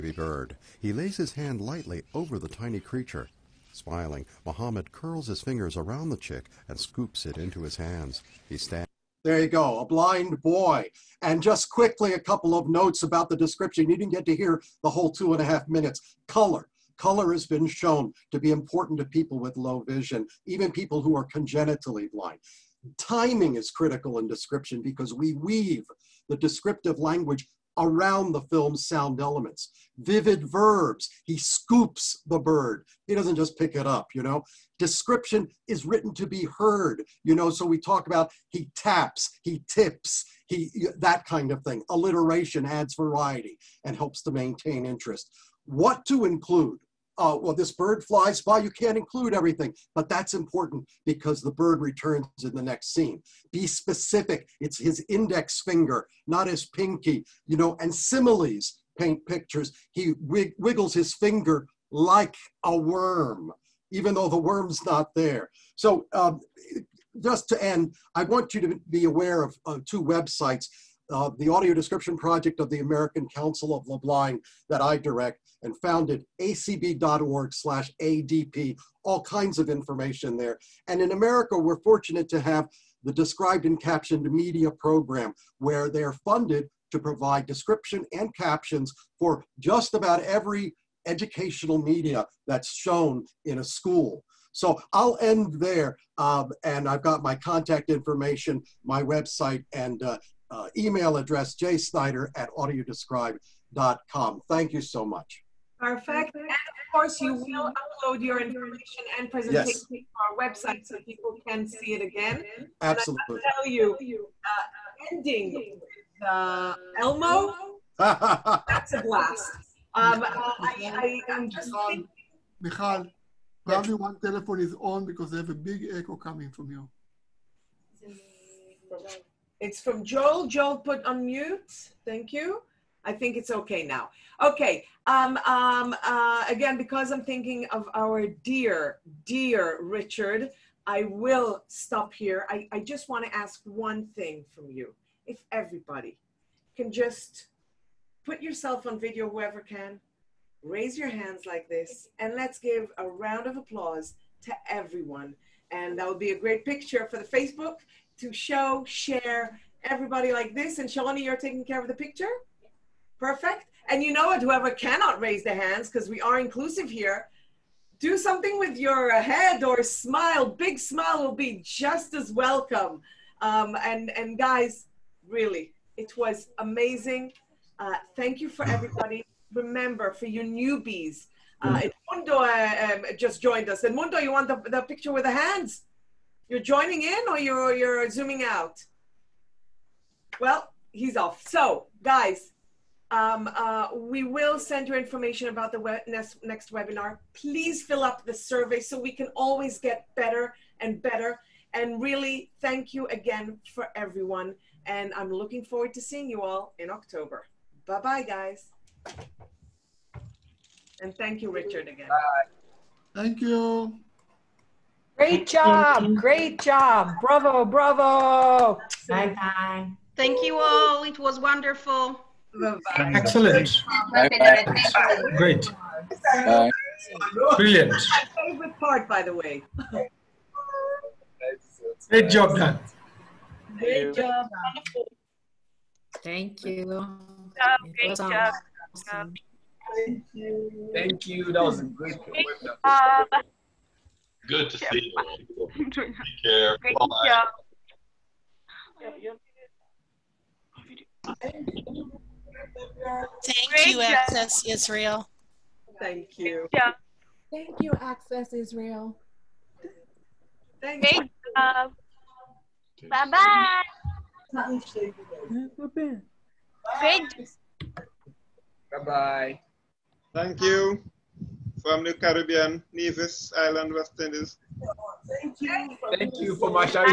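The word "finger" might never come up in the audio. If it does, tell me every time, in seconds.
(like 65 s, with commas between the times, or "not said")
5 s, 55 s, 61 s.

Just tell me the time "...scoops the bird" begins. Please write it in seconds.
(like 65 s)
31 s.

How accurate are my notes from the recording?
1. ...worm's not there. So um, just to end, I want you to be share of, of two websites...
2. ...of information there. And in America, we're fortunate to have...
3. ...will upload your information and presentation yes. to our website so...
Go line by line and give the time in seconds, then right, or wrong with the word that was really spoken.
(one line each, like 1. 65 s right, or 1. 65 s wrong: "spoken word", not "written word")
1. 64 s wrong: "aware", not "share"
2. 79 s right
3. 107 s right.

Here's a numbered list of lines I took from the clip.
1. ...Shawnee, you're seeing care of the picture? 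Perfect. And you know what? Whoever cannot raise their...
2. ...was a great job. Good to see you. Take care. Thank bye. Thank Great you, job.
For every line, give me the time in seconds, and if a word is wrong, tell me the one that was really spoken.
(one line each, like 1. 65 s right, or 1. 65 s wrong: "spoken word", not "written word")
1. 160 s wrong: "taking", not "seeing"
2. 241 s right.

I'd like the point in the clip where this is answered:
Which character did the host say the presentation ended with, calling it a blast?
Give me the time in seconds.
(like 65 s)
116 s.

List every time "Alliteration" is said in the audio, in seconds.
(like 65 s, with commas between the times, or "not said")
41 s.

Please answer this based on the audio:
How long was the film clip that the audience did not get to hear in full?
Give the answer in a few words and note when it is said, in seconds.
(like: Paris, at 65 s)
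2 and a half minutes, at 15 s.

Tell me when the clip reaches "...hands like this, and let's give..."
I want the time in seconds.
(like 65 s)
151 s.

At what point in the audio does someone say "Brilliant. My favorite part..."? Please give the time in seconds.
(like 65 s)
227 s.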